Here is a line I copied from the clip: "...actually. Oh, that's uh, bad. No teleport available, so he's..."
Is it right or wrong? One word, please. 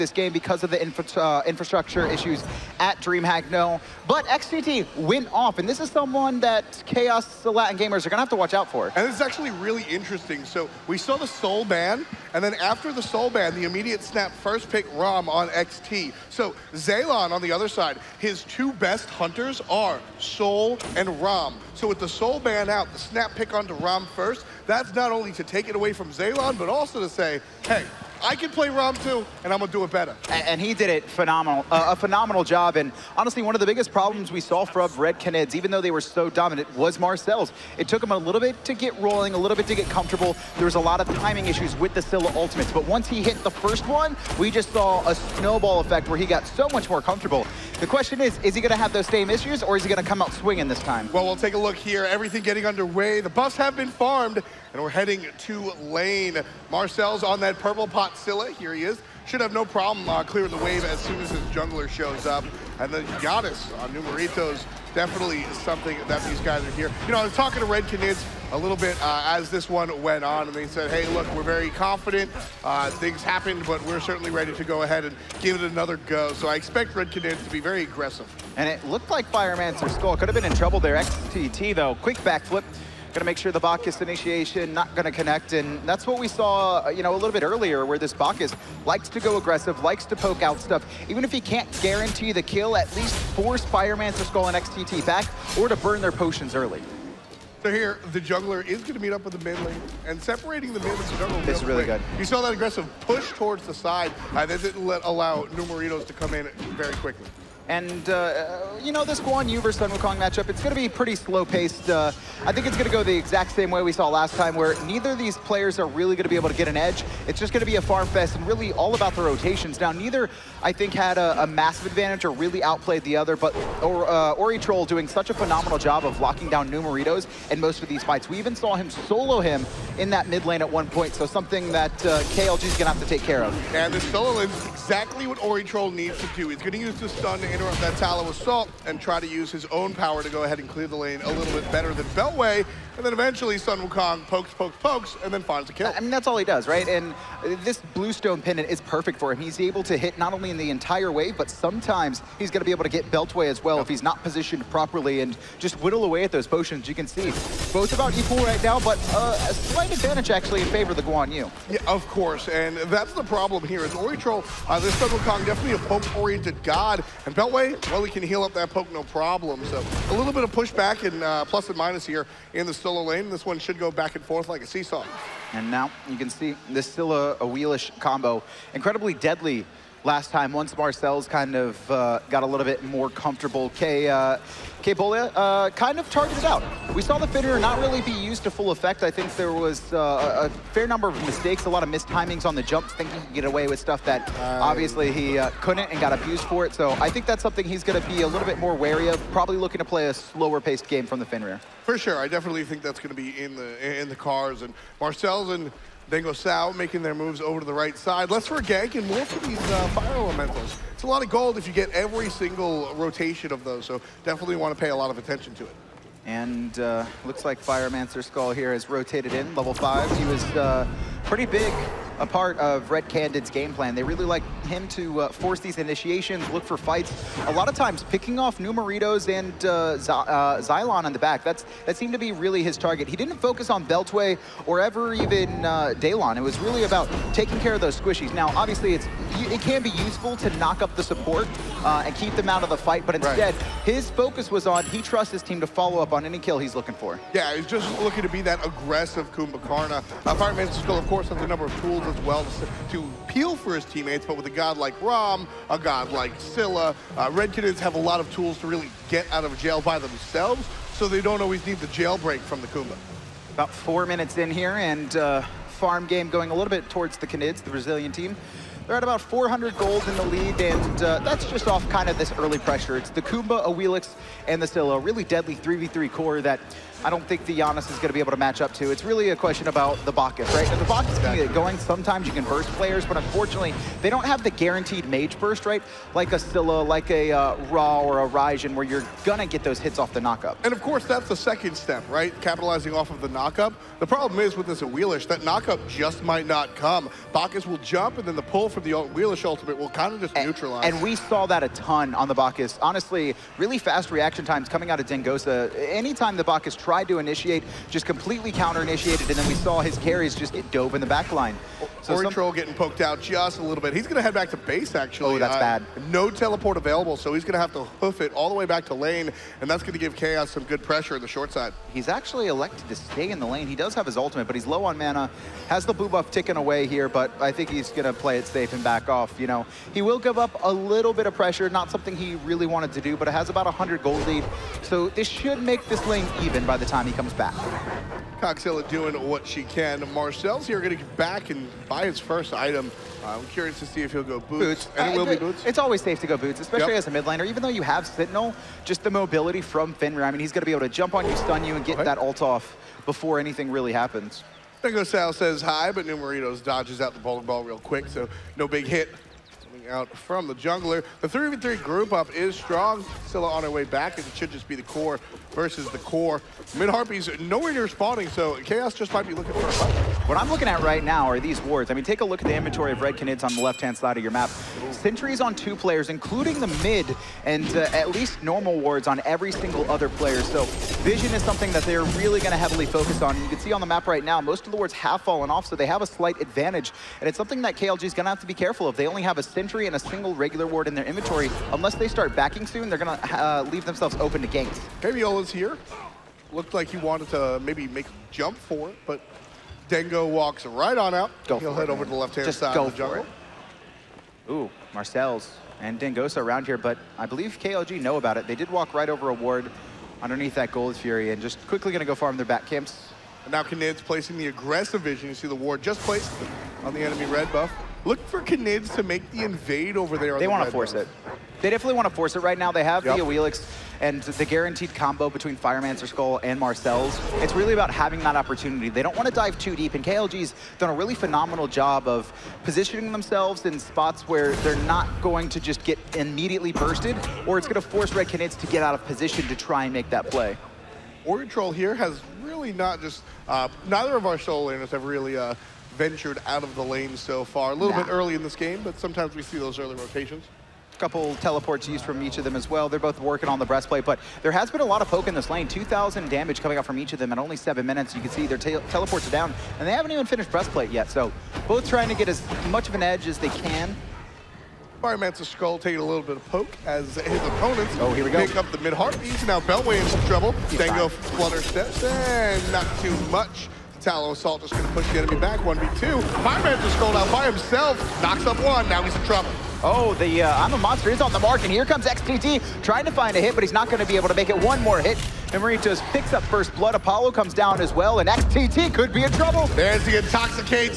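right.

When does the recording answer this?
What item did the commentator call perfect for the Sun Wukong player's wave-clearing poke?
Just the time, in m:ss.
2:27.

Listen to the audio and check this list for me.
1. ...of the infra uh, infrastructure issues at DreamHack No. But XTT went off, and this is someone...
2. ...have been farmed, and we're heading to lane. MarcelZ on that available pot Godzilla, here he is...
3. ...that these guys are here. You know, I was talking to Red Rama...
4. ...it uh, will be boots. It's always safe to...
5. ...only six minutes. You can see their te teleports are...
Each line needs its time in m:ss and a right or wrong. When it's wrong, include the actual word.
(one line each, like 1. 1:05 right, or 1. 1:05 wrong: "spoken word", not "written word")
1. 0:00 right
2. 0:53 wrong: "purple", not "available"
3. 1:06 wrong: "Canids", not "Rama"
4. 5:45 right
5. 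7:37 wrong: "seven", not "six".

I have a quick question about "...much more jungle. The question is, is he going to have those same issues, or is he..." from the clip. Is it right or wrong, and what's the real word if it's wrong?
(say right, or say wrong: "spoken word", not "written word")
wrong: "comfortable", not "jungle".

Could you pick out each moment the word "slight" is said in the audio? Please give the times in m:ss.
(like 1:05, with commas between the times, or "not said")
2:39, 6:26.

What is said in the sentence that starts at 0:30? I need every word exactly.
And, and he did it phenomenal, uh, a phenomenal job.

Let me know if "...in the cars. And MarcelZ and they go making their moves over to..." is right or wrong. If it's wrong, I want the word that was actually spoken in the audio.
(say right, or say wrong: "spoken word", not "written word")
right.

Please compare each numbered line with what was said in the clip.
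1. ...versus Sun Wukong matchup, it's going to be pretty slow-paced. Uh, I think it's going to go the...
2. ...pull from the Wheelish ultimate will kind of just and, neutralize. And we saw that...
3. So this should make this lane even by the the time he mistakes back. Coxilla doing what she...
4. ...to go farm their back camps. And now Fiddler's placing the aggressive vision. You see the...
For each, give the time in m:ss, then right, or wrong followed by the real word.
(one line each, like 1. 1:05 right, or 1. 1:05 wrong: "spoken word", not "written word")
1. 1:49 right
2. 4:58 right
3. 5:34 wrong: "comes", not "mistakes"
4. 6:51 wrong: "Canid", not "Fiddler".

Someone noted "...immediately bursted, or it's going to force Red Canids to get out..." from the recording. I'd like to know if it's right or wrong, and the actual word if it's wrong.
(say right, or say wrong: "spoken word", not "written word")
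right.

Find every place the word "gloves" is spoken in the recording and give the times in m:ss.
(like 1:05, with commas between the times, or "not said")
not said.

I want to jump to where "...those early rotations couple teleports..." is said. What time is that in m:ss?
7:29.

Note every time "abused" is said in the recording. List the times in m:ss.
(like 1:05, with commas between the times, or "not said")
3:16.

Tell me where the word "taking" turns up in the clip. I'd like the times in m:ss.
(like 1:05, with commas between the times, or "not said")
3:57, 7:45.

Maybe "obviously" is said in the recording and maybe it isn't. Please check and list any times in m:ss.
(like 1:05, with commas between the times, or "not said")
3:14, 3:58.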